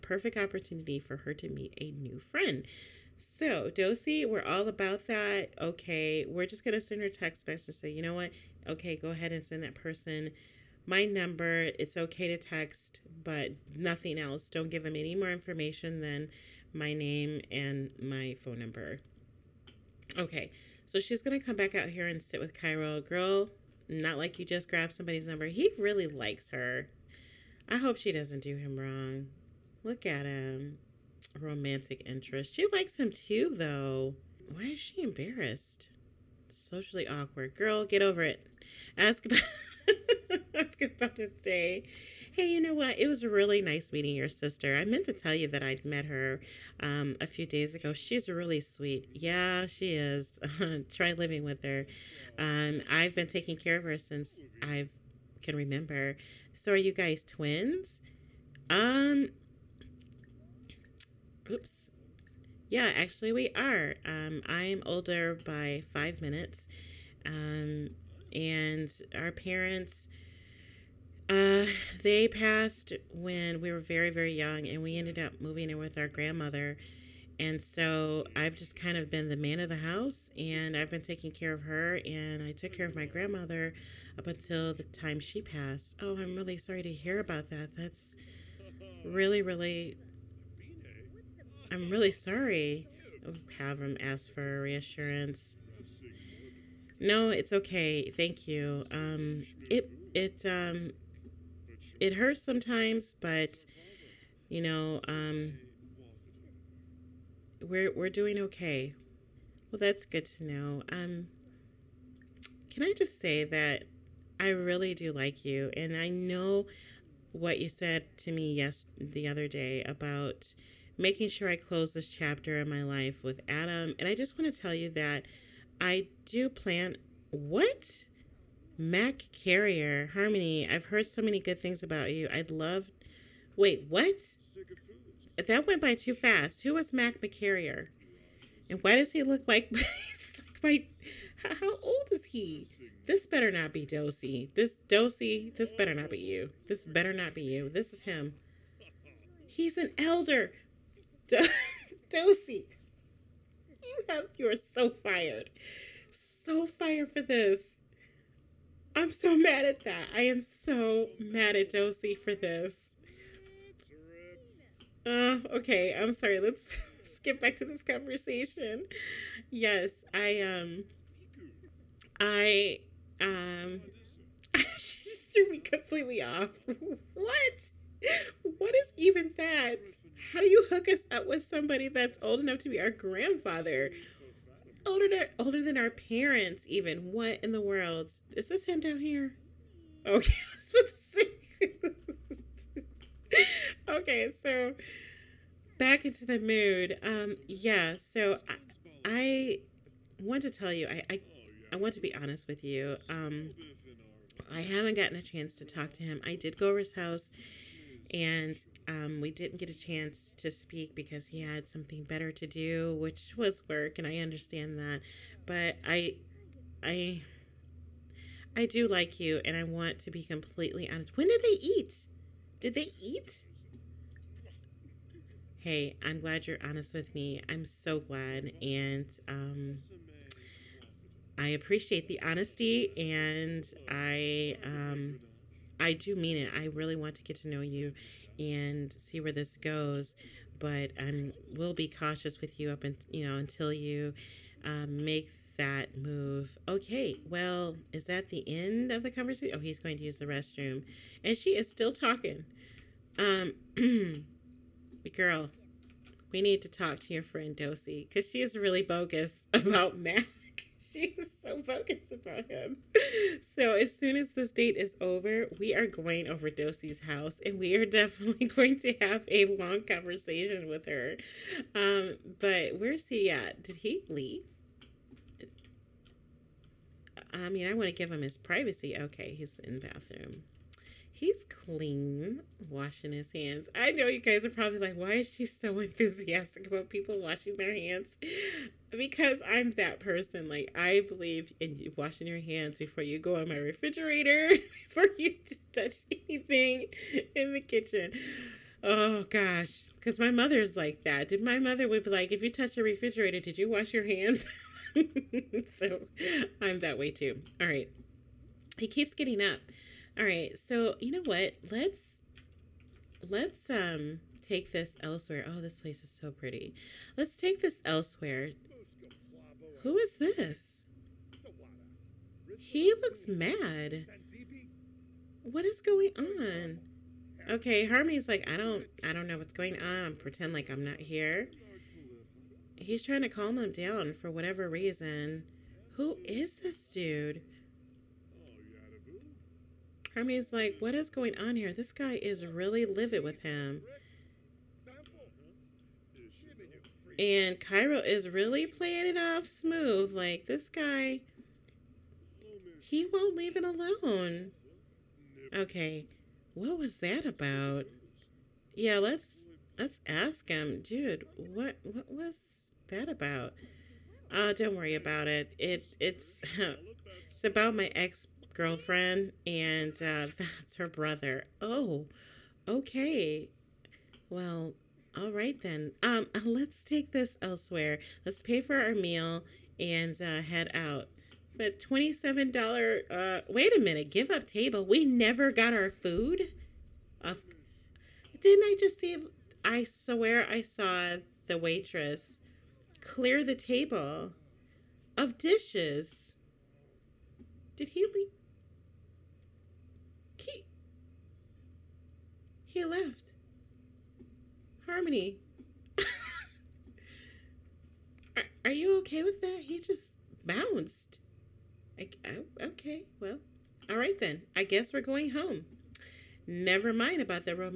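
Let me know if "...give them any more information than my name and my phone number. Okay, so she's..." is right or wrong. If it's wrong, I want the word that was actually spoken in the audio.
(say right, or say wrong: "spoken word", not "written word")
right.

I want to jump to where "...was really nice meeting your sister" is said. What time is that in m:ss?
0:43.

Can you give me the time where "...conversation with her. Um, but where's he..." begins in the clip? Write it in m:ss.
4:29.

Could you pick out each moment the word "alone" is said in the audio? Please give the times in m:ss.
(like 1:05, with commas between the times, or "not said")
5:53.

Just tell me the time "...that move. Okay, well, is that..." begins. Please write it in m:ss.
4:05.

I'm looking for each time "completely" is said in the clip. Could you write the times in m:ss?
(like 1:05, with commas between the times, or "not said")
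2:55, 3:40.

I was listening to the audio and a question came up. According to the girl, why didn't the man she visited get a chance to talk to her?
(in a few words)
work.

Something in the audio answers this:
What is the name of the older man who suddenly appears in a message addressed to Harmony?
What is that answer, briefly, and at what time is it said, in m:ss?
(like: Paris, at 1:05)
Mac McCarrier, at 2:16.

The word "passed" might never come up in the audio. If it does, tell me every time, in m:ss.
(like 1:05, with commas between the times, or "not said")
1:12, 1:25.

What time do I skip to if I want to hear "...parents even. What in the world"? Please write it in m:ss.
3:05.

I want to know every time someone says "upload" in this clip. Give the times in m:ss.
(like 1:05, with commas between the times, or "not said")
not said.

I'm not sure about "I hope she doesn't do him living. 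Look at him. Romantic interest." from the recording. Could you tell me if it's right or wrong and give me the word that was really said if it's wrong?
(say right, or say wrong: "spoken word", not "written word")
wrong: "wrong", not "living".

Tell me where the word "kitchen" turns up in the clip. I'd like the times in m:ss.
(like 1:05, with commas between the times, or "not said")
4:57.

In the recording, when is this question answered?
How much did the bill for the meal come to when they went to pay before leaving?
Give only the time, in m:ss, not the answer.
6:21.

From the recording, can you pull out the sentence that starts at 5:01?
Did my mother would be like, if you touch a refrigerator, did you wash your hands?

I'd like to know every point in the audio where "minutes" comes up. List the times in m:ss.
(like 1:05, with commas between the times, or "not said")
1:06, 6:23.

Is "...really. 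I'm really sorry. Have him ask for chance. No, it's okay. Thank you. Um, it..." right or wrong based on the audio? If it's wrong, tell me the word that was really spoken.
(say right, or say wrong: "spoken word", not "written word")
wrong: "reassurance", not "chance".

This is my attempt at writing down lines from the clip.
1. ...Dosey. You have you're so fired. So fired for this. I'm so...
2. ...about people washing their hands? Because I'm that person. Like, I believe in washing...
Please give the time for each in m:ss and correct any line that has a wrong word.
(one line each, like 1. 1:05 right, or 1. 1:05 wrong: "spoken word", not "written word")
1. 2:32 right
2. 4:46 right.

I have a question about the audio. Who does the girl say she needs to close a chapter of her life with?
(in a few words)
Adam.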